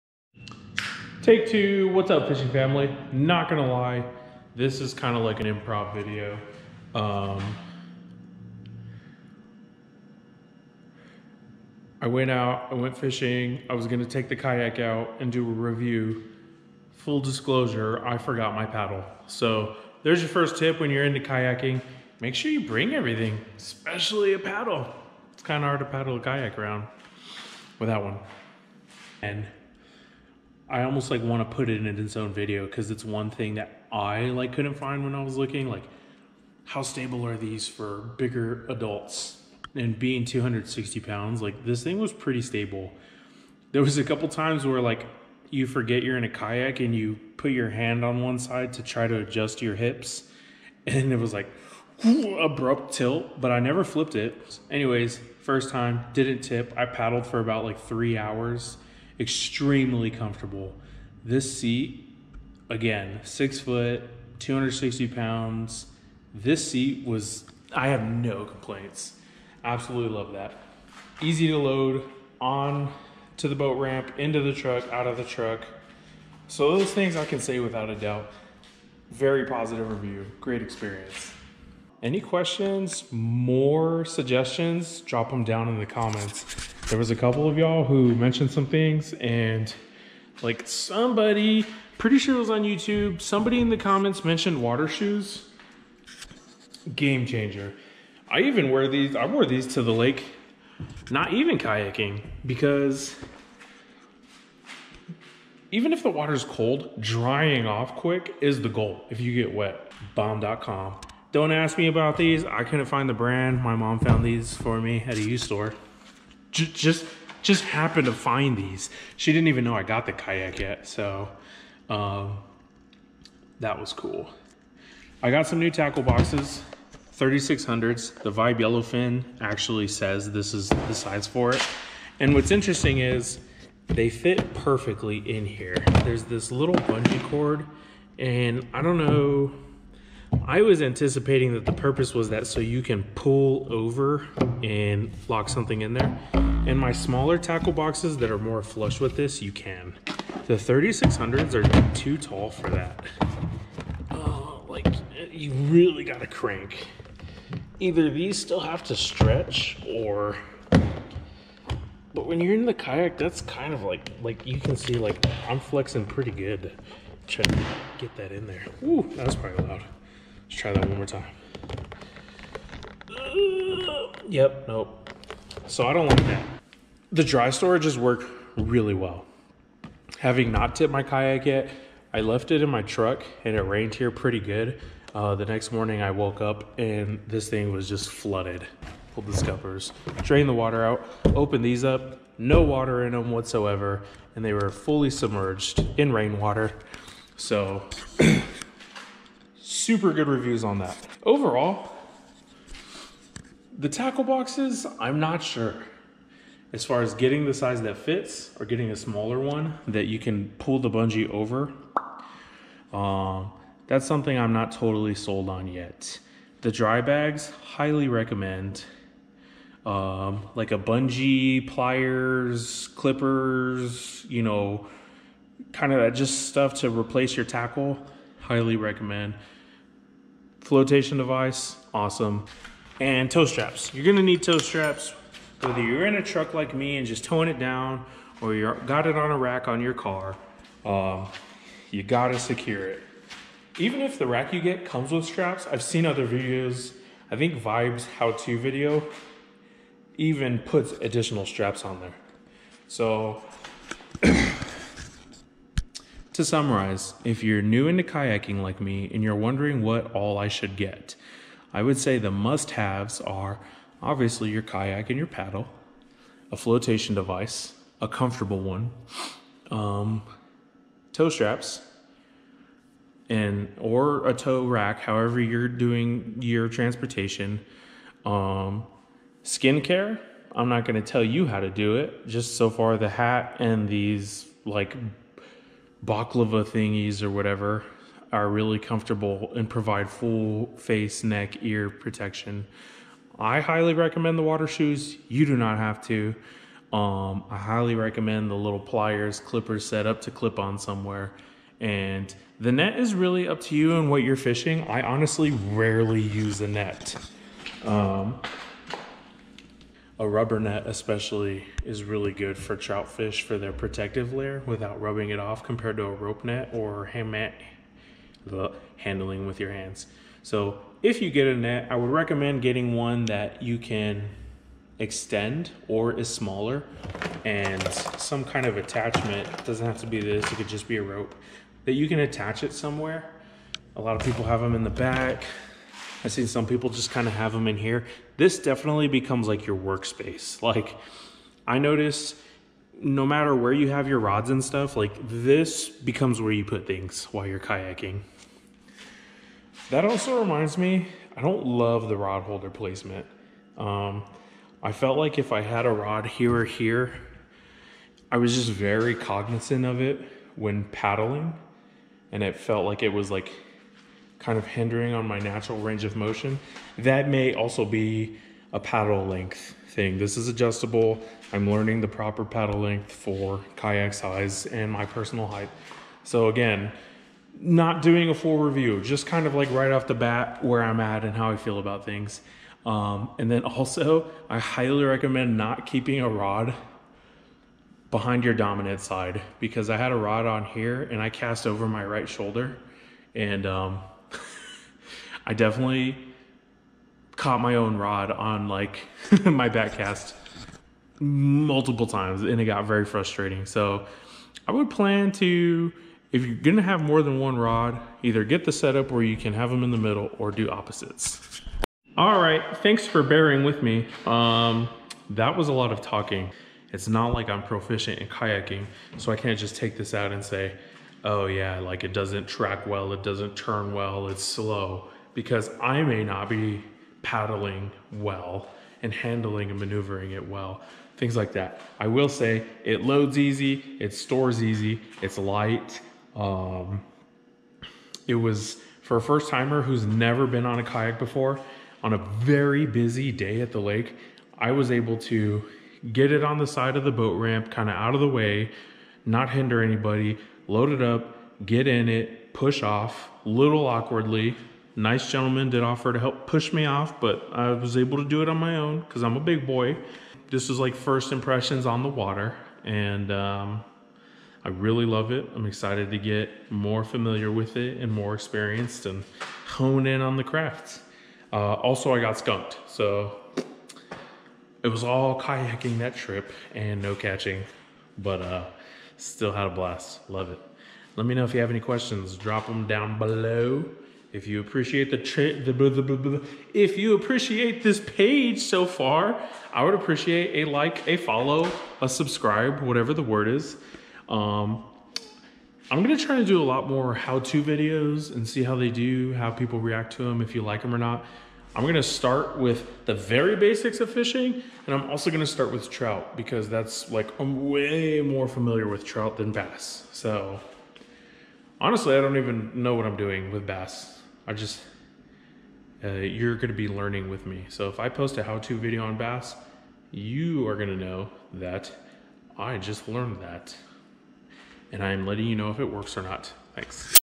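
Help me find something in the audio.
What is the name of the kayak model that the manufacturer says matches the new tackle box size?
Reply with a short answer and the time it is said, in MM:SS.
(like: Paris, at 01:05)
Vibe Yellowfin, at 02:08.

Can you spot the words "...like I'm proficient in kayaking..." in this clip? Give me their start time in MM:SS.
06:57.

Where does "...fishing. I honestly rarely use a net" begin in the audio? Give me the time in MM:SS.
05:04.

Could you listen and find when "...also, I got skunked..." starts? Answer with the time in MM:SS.
07:51.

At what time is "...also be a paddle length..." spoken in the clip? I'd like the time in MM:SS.
06:07.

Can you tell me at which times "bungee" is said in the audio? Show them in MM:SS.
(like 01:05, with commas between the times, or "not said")
02:16, 03:30, 03:40.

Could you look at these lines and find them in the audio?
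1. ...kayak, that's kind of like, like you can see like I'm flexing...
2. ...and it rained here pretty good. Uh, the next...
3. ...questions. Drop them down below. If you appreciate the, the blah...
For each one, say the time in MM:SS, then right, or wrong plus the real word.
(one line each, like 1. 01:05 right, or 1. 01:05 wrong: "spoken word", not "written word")
1. 02:42 right
2. 03:03 right
3. 08:01 right.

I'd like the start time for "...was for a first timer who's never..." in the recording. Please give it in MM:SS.
07:18.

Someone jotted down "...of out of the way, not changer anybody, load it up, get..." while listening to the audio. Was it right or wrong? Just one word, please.
wrong.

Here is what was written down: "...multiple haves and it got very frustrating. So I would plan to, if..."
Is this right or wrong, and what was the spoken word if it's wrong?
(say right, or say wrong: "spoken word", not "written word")
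wrong: "times", not "haves".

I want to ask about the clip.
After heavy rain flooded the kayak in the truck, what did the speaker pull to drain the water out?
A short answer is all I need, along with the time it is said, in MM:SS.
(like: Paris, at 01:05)
scuppers, at 03:09.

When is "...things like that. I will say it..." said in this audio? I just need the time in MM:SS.
07:11.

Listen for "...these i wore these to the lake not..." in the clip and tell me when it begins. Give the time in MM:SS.
01:38.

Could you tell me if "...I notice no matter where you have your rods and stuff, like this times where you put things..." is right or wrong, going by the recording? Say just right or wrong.
wrong.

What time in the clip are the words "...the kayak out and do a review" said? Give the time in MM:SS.
00:14.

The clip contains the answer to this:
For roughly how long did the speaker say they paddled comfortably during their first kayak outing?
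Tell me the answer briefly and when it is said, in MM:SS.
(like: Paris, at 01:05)
about 3 hours, at 00:57.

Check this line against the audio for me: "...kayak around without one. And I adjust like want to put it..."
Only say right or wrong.
wrong.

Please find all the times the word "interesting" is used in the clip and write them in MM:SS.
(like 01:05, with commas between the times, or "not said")
02:12.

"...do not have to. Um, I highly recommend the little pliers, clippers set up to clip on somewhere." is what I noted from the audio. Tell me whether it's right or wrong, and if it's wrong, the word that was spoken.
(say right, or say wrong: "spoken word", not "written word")
right.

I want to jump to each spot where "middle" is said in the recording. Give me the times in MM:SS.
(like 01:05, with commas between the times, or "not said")
06:49.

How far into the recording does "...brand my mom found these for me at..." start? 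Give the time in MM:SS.
01:53.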